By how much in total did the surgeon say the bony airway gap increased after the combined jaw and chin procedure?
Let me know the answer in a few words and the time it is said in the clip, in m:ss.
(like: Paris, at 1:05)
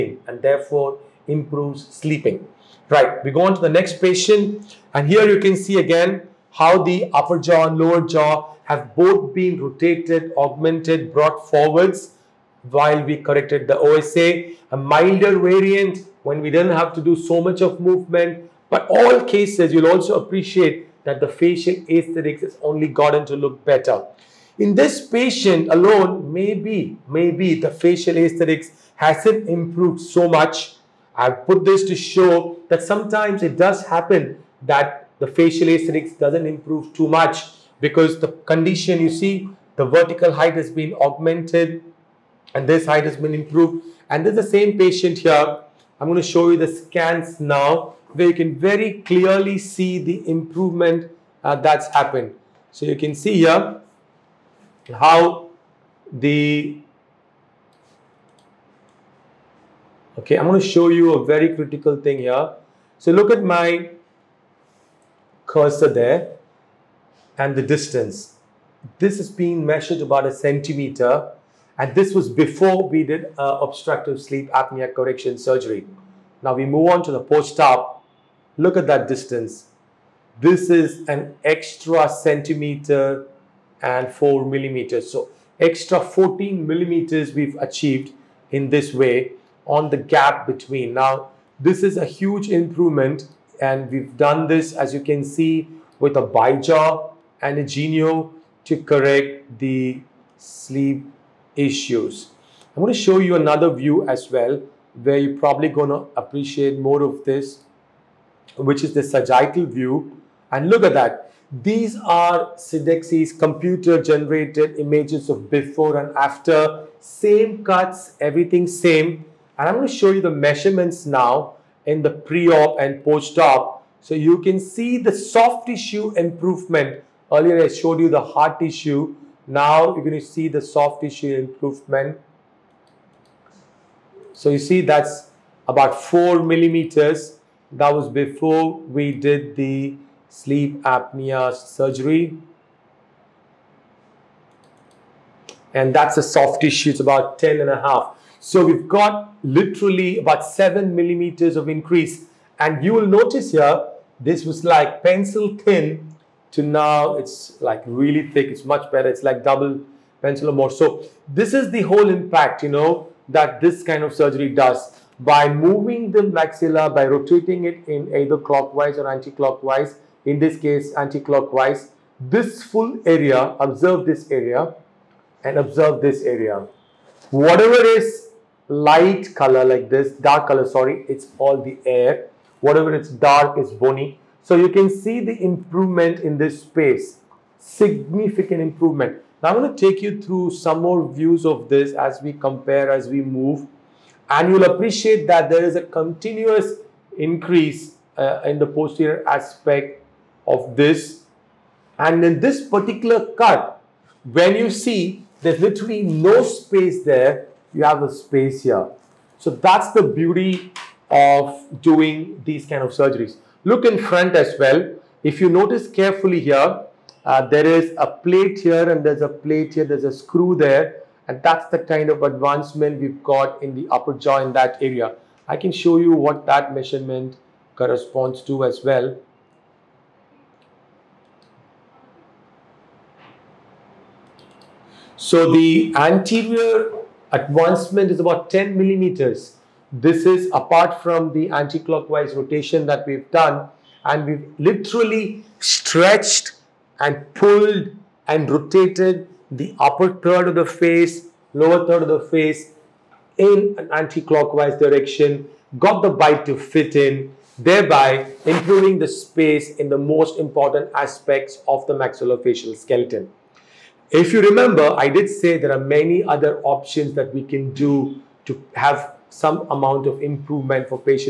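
14 millimeters, at 1:25.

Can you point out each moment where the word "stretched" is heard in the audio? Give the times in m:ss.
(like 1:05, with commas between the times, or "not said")
4:05.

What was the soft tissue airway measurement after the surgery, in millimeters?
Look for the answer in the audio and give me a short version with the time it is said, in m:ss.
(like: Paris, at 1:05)
10.5, at 2:27.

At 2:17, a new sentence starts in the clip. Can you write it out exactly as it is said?
That was before we did the sleep apnea surgery.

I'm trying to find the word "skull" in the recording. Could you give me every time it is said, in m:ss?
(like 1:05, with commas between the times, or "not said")
not said.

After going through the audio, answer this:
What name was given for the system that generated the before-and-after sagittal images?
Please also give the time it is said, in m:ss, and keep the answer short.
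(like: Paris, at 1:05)
Sidexis, at 1:52.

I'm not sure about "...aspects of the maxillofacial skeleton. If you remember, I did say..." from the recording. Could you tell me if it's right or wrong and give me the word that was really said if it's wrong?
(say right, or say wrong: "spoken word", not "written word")
right.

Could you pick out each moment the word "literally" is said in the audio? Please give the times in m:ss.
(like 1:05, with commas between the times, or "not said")
2:29, 3:25, 4:04.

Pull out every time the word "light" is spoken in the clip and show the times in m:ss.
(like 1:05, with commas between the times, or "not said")
2:58.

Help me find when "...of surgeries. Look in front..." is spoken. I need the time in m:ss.
3:32.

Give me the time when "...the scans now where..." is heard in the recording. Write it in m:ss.
0:46.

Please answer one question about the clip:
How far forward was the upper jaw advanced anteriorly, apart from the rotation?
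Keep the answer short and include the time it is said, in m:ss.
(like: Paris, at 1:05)
10 millimeters, at 3:58.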